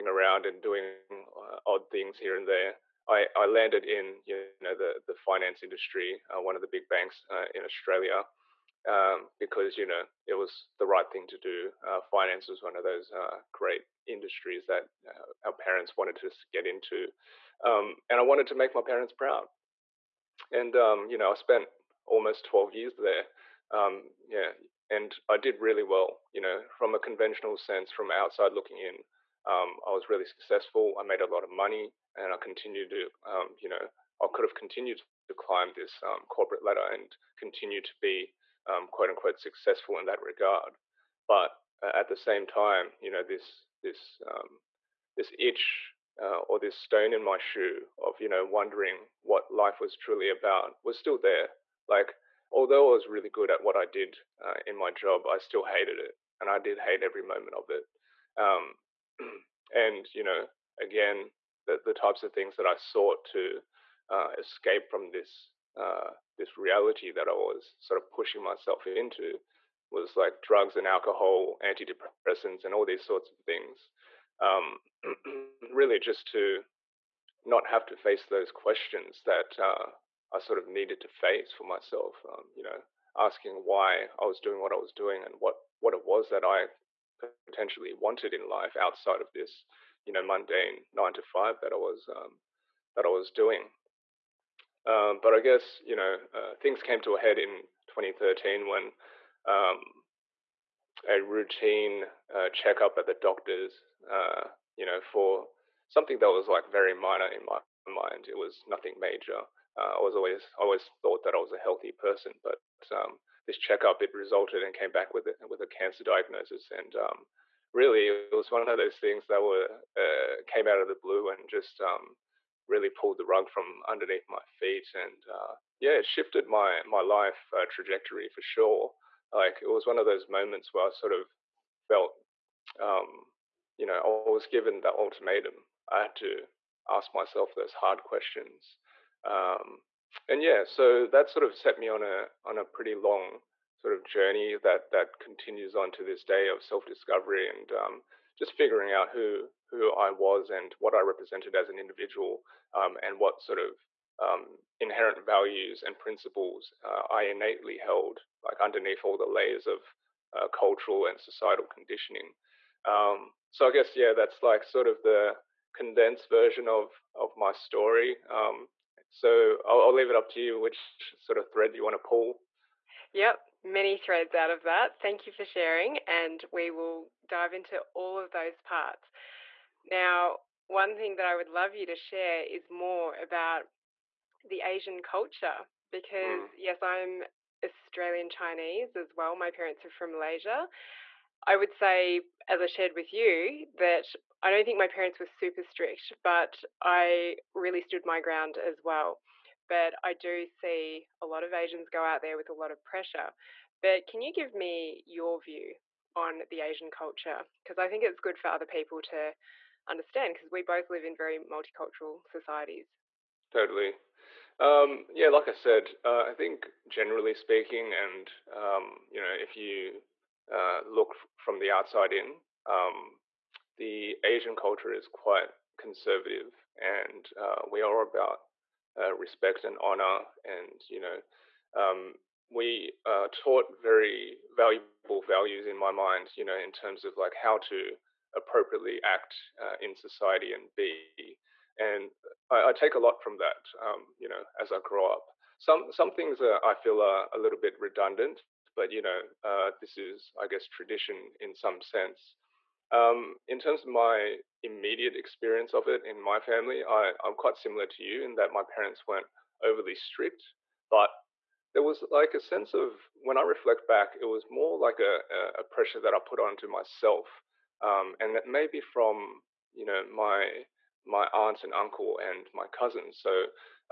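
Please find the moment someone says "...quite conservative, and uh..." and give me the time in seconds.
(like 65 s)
225 s.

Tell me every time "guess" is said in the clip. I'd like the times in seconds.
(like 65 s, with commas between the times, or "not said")
95 s, 163 s, 250 s.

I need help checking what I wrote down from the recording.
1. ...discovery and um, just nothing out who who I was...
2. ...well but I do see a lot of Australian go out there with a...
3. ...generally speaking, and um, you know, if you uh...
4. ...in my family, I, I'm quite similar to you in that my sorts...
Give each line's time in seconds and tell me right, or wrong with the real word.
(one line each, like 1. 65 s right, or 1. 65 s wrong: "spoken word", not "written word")
1. 146 s wrong: "figuring", not "nothing"
2. 198 s wrong: "Asians", not "Australian"
3. 216 s right
4. 256 s wrong: "parents", not "sorts".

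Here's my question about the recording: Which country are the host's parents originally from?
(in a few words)
Malaysia.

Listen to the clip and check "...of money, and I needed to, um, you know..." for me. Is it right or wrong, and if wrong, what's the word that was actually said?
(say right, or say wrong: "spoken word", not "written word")
wrong: "continued", not "needed".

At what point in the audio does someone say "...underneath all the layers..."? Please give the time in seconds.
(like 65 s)
158 s.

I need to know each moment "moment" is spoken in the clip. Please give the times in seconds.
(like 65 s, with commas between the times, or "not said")
57 s, 130 s.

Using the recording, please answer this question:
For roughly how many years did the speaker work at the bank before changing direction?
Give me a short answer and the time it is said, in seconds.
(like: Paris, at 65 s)
12 years, at 22 s.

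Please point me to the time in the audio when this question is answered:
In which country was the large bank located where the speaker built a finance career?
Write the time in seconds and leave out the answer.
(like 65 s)
7 s.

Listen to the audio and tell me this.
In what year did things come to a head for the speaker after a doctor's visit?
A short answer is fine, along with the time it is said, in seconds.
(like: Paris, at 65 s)
2013, at 97 s.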